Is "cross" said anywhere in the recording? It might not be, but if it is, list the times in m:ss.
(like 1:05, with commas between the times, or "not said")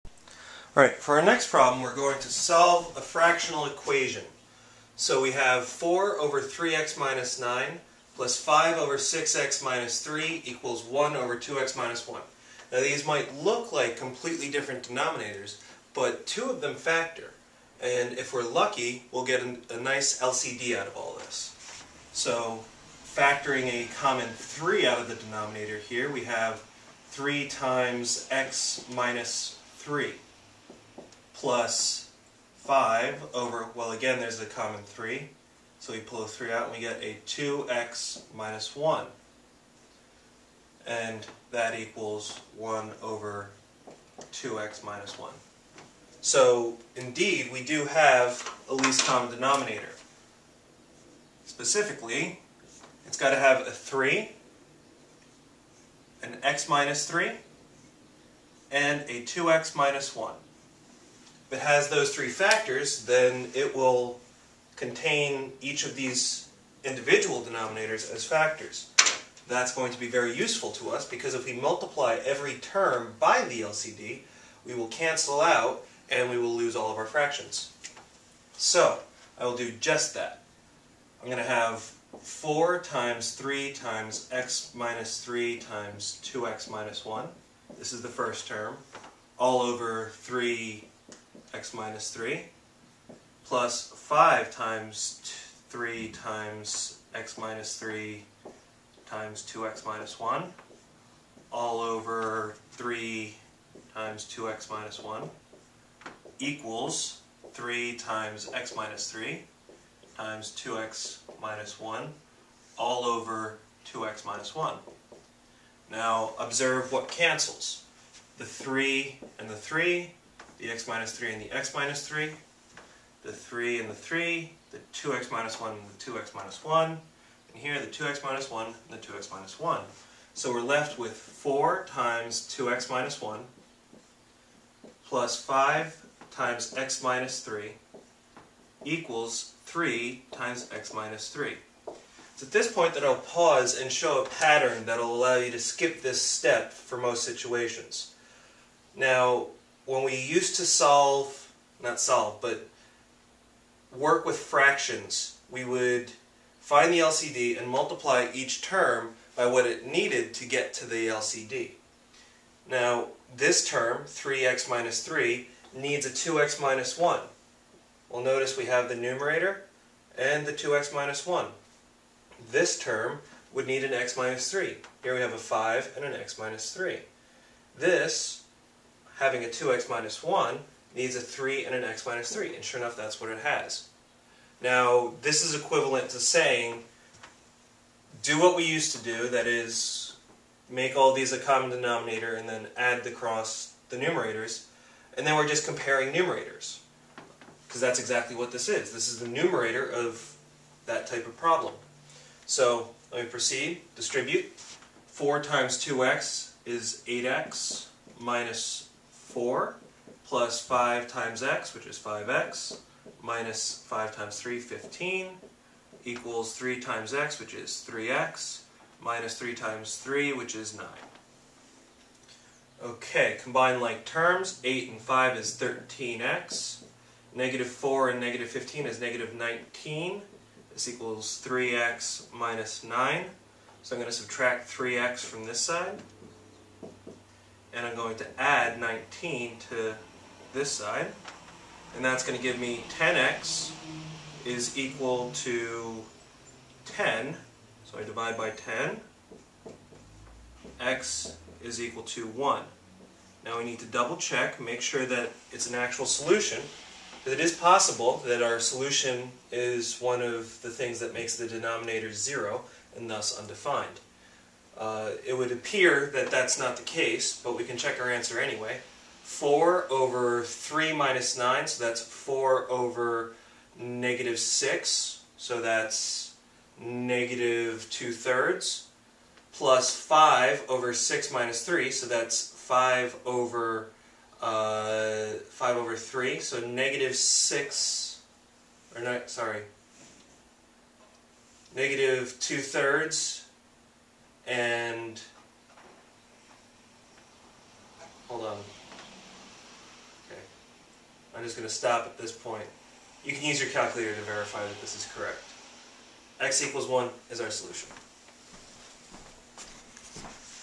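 3:13.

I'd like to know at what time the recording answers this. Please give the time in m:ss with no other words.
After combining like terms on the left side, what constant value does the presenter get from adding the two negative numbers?
3:48.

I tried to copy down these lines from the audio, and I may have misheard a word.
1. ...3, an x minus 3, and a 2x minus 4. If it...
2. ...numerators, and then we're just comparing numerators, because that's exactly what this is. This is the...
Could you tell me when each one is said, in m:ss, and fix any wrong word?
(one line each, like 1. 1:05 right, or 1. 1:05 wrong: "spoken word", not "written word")
1. 0:53 wrong: "1", not "4"
2. 3:13 right.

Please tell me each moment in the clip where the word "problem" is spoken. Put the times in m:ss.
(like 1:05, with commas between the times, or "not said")
0:01, 3:21.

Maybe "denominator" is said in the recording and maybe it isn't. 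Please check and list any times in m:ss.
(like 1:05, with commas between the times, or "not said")
0:14, 0:25, 0:49, 1:07, 3:11, 4:21.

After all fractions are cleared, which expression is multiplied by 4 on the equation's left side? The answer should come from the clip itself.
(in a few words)
2x minus 1.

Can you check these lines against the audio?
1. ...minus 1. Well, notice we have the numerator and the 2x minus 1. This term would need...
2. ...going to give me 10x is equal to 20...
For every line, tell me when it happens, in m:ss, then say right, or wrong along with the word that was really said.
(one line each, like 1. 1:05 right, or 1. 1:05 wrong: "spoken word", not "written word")
1. 2:46 right
2. 4:02 wrong: "10", not "20".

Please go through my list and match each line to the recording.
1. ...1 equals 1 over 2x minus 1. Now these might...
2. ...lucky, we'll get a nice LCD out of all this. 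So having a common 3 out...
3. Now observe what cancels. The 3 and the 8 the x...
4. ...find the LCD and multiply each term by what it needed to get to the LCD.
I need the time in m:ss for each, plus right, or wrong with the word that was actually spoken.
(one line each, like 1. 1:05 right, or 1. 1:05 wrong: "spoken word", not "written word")
1. 0:10 wrong: "3", not "1"
2. 0:18 wrong: "factoring", not "having"
3. 1:55 wrong: "3", not "8"
4. 2:36 right.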